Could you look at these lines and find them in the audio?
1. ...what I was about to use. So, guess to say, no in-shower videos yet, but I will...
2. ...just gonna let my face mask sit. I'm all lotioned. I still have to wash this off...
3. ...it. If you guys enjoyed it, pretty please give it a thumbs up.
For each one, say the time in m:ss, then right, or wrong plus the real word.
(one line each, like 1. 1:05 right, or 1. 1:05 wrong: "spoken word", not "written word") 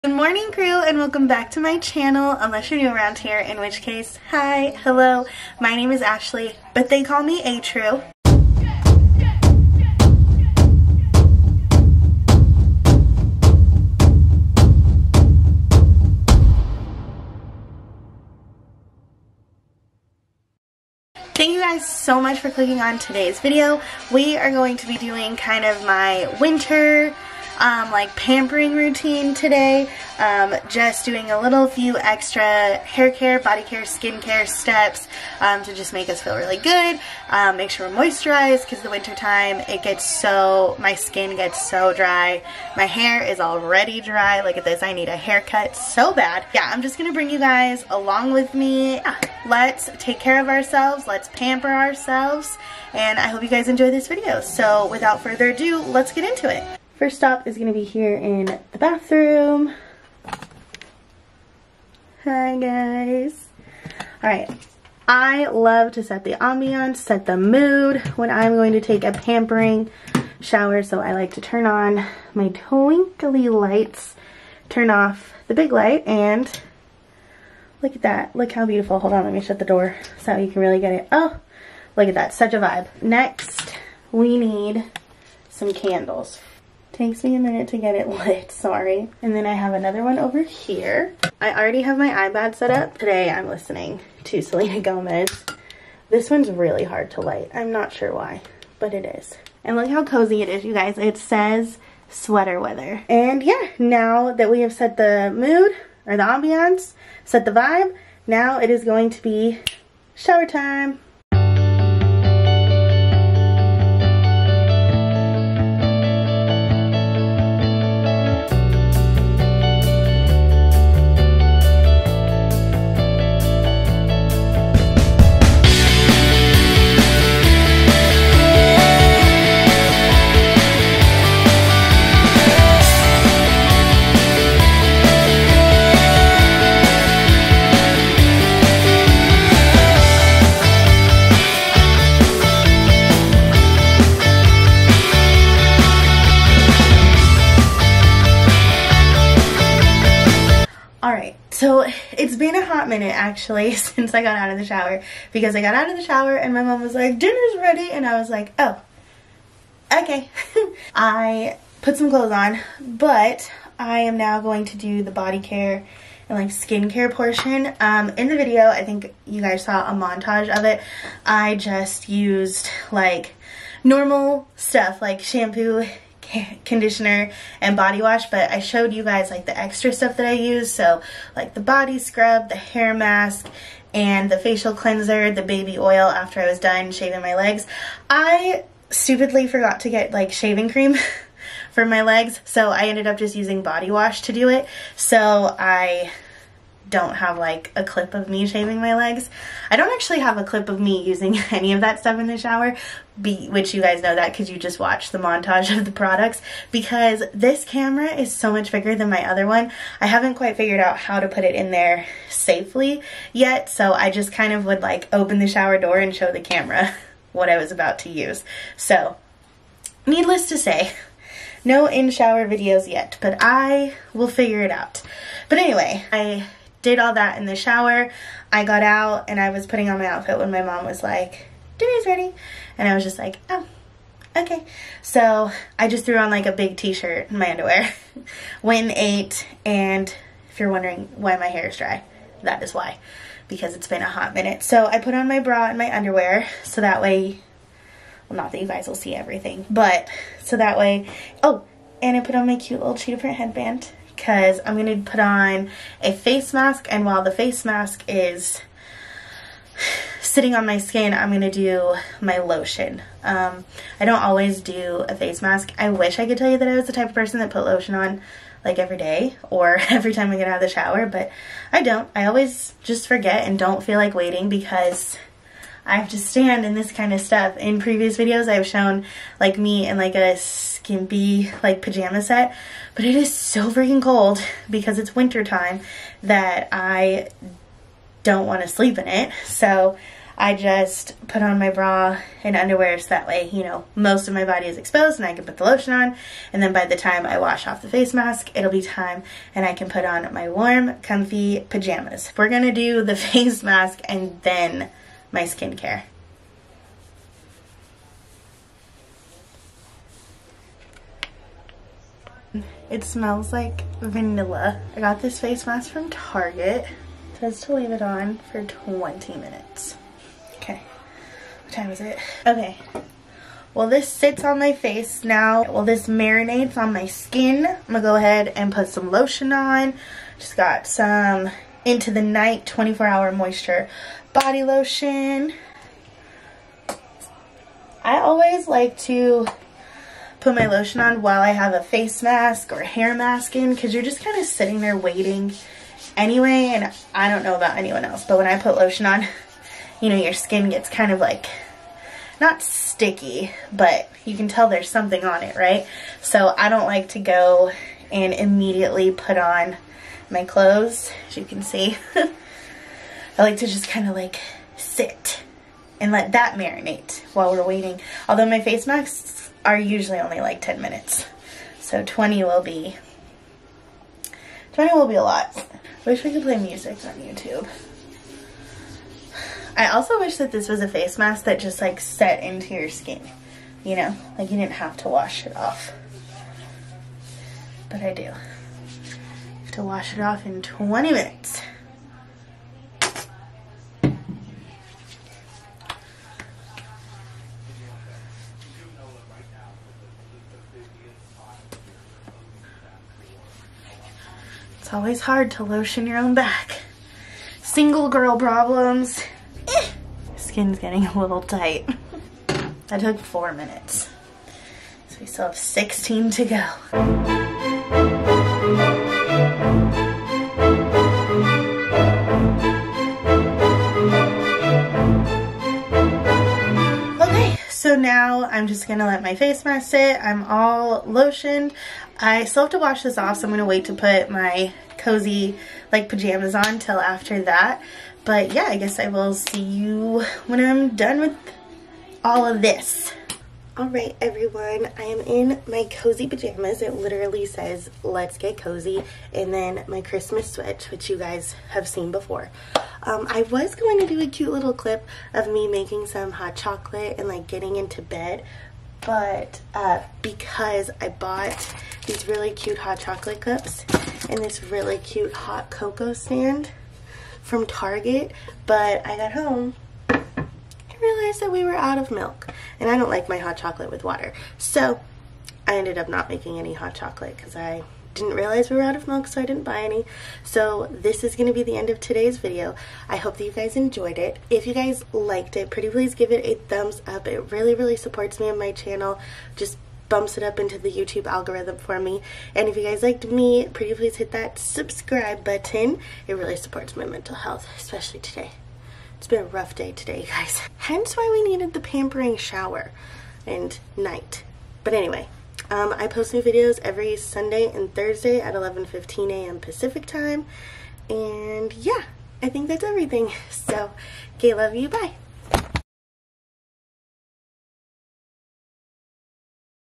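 1. 3:37 wrong: "needless", not "guess"
2. 7:08 right
3. 8:04 wrong: "liked", not "enjoyed".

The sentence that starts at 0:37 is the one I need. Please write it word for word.
Um, make sure we're moisturized because the winter time it gets so, my skin gets so dry.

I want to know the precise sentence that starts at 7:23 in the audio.
All right, everyone, I am in my cozy pajamas.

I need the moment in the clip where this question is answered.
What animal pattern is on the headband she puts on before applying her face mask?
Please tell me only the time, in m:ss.
4:12.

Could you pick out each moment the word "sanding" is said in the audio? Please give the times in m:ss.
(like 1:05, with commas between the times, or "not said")
not said.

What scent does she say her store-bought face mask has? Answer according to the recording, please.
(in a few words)
Vanilla.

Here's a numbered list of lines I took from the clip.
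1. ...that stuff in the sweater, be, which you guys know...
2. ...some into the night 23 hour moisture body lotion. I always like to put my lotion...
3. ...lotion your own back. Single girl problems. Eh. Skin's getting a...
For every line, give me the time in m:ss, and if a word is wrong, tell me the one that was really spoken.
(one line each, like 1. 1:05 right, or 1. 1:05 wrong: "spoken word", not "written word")
1. 3:21 wrong: "shower", not "sweater"
2. 5:30 wrong: "24", not "23"
3. 6:45 right.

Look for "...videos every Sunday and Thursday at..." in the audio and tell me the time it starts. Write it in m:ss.
8:26.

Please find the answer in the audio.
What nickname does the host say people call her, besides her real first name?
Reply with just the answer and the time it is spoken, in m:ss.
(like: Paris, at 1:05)
ATRU, at 0:07.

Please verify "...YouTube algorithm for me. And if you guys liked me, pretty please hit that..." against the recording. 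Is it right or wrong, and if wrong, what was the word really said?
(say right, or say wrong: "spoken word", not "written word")
right.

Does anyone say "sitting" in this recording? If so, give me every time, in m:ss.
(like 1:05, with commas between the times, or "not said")
4:20, 5:44.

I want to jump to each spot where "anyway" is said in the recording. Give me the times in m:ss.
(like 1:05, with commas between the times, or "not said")
3:45, 5:46, 8:24.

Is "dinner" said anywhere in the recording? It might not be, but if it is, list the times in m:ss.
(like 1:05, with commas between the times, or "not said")
2:37, 3:51.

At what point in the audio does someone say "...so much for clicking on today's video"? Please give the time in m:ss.
0:21.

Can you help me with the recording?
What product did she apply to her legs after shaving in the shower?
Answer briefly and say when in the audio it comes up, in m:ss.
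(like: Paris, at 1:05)
Baby oil, at 3:05.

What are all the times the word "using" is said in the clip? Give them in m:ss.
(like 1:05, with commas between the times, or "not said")
3:13, 3:21.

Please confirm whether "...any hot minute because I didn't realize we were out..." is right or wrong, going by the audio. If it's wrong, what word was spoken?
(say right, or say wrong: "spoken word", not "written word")
wrong: "chocolate", not "minute".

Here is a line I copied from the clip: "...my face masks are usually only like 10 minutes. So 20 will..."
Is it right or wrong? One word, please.
right.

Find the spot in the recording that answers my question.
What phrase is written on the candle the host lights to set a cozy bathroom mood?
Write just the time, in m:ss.
1:42.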